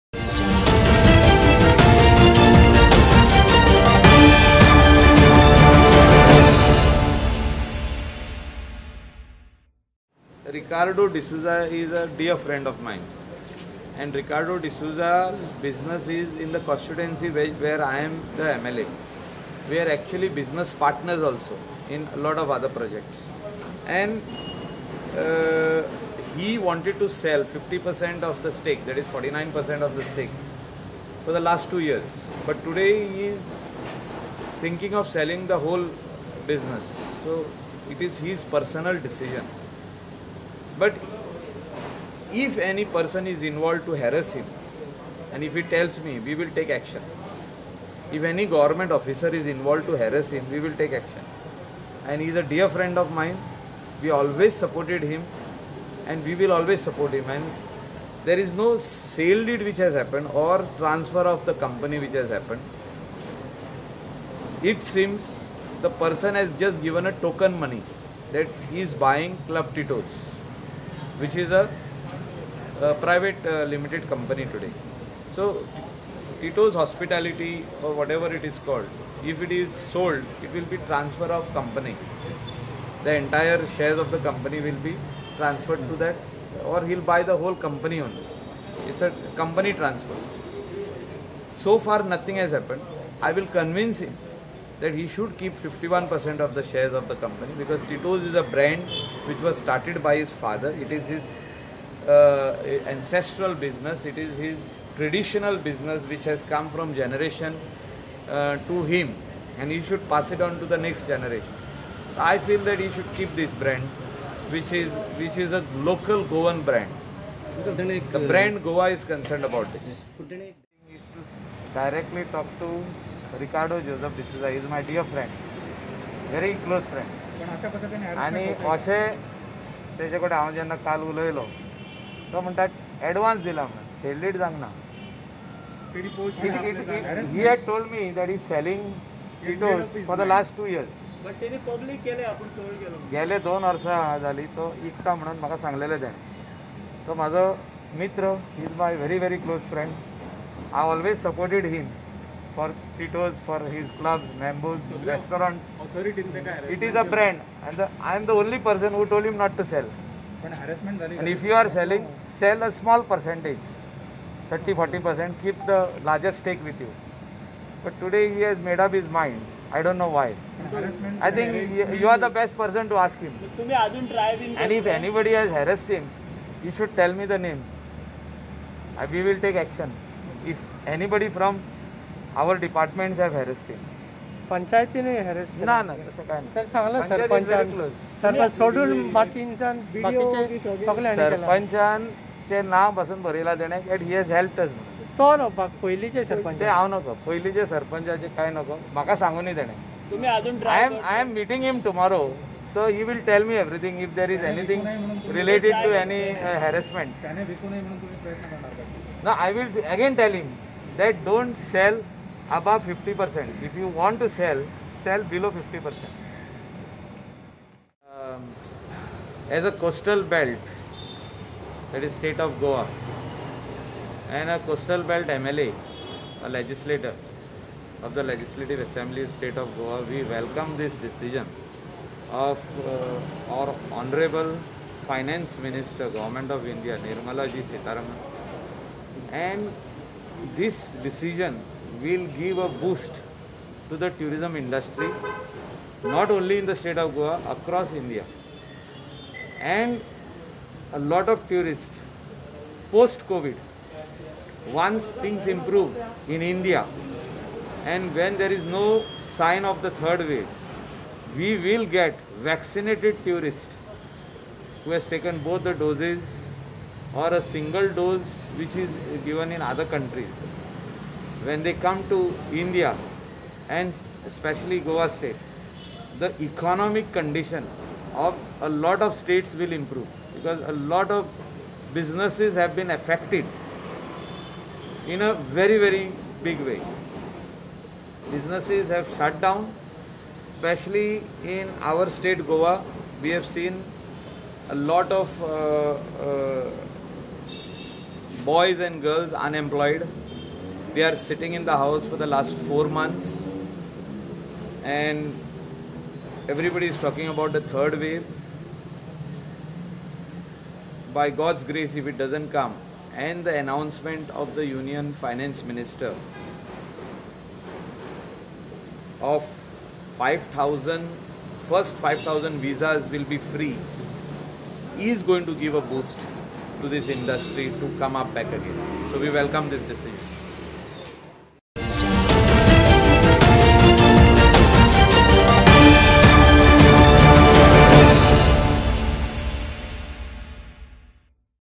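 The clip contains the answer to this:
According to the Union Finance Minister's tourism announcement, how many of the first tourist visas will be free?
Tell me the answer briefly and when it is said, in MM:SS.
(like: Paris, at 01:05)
5,000, at 05:21.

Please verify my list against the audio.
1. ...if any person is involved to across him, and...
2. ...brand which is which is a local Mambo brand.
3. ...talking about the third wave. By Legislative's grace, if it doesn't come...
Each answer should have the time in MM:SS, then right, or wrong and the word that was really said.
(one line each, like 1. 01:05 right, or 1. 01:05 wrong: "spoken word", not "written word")
1. 00:42 wrong: "harass", not "across"
2. 01:53 wrong: "Goan", not "Mambo"
3. 05:06 wrong: "God", not "Legislative".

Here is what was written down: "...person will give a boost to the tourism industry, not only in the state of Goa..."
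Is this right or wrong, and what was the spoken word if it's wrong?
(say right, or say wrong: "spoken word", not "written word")
wrong: "decision", not "person".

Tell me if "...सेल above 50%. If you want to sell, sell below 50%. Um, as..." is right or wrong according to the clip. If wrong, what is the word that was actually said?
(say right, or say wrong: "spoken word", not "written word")
right.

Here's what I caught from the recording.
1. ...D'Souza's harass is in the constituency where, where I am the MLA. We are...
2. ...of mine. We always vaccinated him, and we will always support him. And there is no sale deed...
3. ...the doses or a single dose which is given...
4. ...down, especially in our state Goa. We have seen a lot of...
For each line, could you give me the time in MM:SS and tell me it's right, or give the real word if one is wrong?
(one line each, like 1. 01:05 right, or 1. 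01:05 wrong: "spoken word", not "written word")
1. 00:14 wrong: "business", not "harass"
2. 00:52 wrong: "supported", not "vaccinated"
3. 04:25 right
4. 04:49 right.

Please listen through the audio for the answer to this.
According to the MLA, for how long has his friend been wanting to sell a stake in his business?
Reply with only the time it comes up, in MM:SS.
00:31.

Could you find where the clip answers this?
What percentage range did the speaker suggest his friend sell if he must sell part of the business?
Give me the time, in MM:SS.
02:44.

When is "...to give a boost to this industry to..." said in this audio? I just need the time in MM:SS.
05:25.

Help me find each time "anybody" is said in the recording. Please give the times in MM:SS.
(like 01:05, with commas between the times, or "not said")
02:54, 03:00.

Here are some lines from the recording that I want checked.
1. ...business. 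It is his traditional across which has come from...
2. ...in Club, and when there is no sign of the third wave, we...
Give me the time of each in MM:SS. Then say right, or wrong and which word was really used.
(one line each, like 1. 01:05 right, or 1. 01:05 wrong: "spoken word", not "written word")
1. 01:43 wrong: "business", not "across"
2. 04:16 wrong: "India", not "Club".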